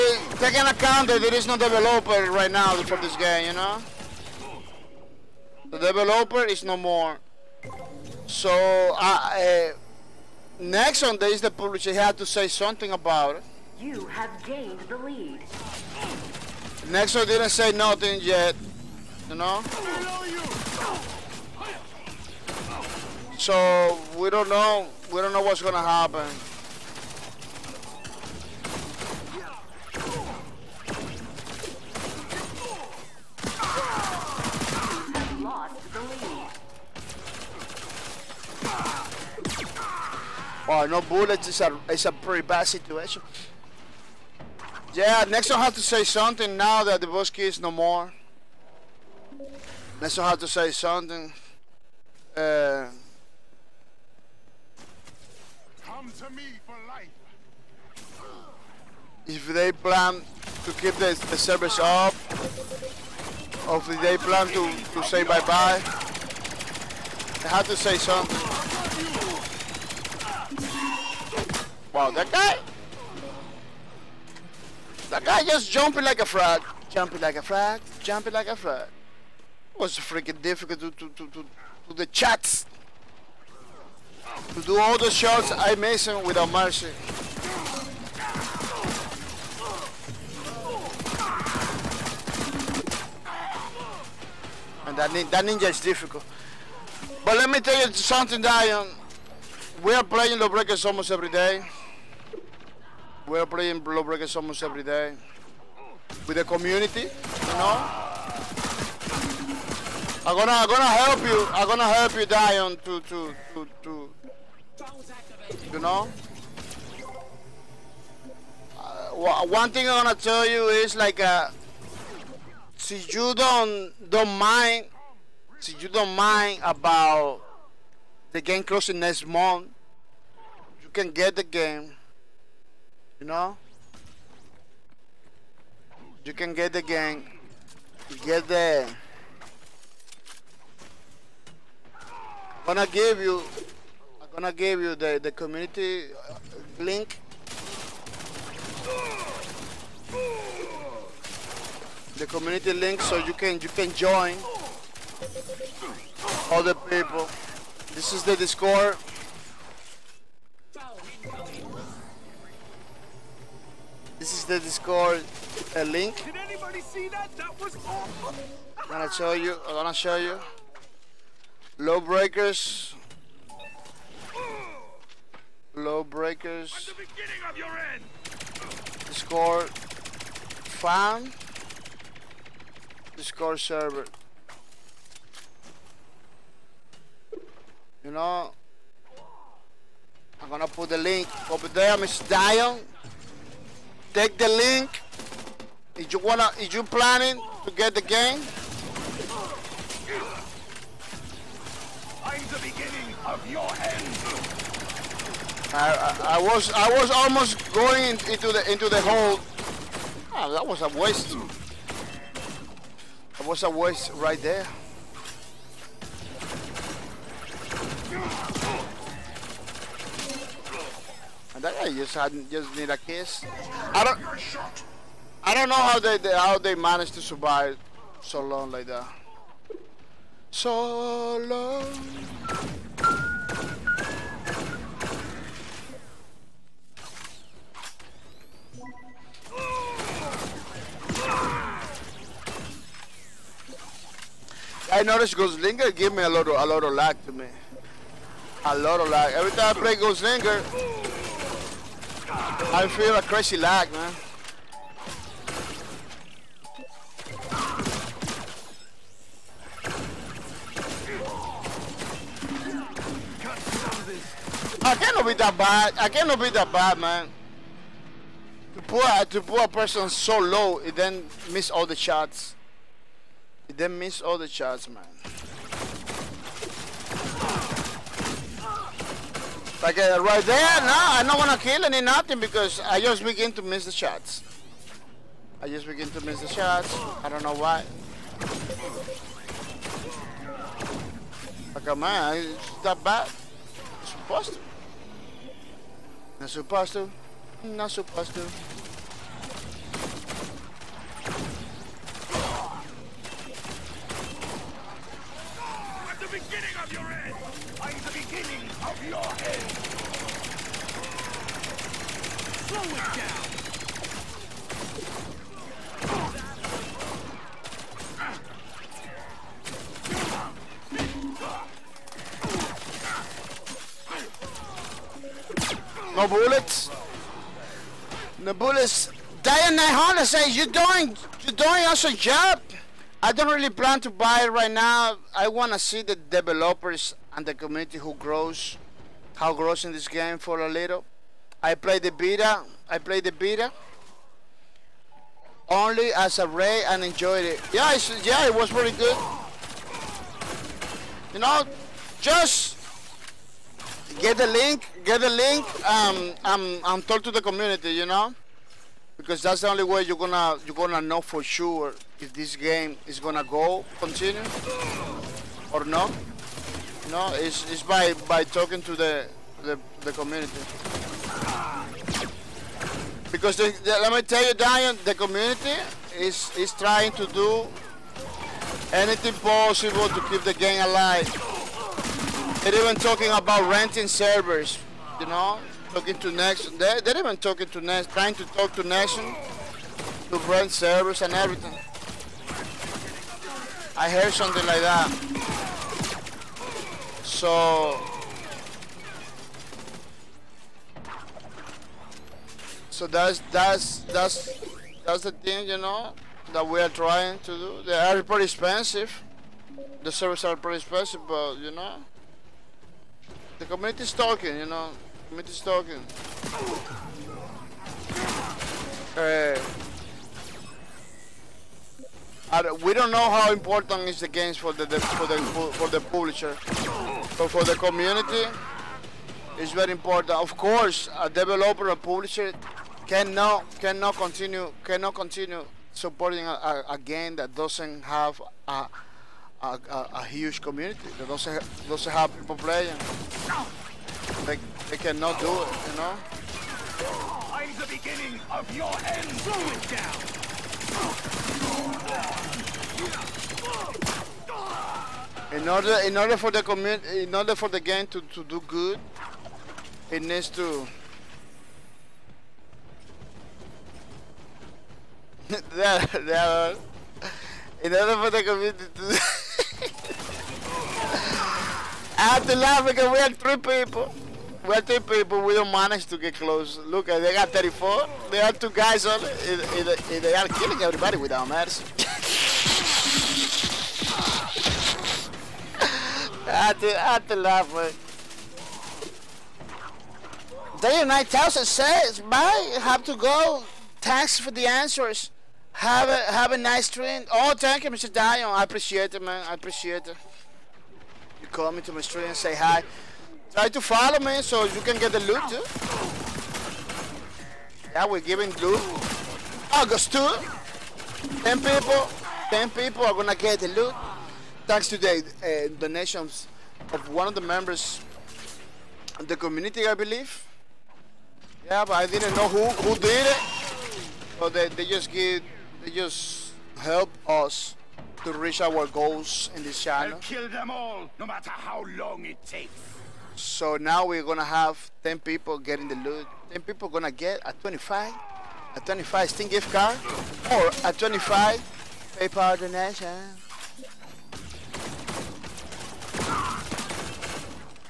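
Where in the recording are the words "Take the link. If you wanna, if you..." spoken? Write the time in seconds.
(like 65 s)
194 s.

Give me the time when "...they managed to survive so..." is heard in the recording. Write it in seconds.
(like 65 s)
226 s.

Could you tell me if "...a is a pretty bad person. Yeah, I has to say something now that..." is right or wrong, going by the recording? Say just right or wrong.
wrong.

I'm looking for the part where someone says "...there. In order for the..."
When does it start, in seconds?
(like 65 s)
466 s.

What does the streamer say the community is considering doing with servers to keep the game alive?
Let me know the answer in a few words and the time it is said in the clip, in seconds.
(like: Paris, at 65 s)
Renting servers, at 383 s.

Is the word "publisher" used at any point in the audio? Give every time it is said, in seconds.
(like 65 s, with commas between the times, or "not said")
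11 s, 425 s, 431 s.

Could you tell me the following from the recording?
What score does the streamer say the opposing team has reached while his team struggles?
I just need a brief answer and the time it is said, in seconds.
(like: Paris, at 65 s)
34, at 477 s.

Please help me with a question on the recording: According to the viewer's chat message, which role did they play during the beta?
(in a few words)
Ray.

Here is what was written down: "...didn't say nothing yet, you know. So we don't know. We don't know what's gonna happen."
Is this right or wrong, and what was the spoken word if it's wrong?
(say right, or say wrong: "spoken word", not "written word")
right.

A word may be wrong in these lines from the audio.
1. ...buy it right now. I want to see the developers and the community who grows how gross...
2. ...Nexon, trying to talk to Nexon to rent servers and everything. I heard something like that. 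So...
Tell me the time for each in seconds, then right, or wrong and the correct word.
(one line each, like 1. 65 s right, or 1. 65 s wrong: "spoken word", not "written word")
1. 334 s right
2. 387 s right.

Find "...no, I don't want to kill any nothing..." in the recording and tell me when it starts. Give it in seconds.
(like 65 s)
280 s.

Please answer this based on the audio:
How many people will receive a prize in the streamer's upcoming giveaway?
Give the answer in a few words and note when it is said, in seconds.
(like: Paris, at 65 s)
10, at 536 s.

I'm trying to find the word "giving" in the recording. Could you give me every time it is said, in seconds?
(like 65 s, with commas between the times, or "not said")
508 s.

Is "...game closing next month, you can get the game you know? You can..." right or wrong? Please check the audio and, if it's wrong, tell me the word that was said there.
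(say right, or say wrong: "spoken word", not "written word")
right.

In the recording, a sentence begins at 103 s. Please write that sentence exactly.
We're playing Lawbreakers almost every day.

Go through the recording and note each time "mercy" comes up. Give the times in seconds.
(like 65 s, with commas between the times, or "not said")
86 s, 481 s.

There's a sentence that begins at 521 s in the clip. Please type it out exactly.
Yeah, but I didn't know who, who did it.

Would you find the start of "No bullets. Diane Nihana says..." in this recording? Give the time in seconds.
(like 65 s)
328 s.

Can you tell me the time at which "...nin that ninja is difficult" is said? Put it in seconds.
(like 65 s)
95 s.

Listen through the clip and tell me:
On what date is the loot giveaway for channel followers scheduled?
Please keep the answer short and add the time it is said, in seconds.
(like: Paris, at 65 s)
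August 2, at 509 s.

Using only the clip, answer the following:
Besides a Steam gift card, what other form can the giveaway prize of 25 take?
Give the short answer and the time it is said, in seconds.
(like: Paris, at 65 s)
PayPal donation, at 542 s.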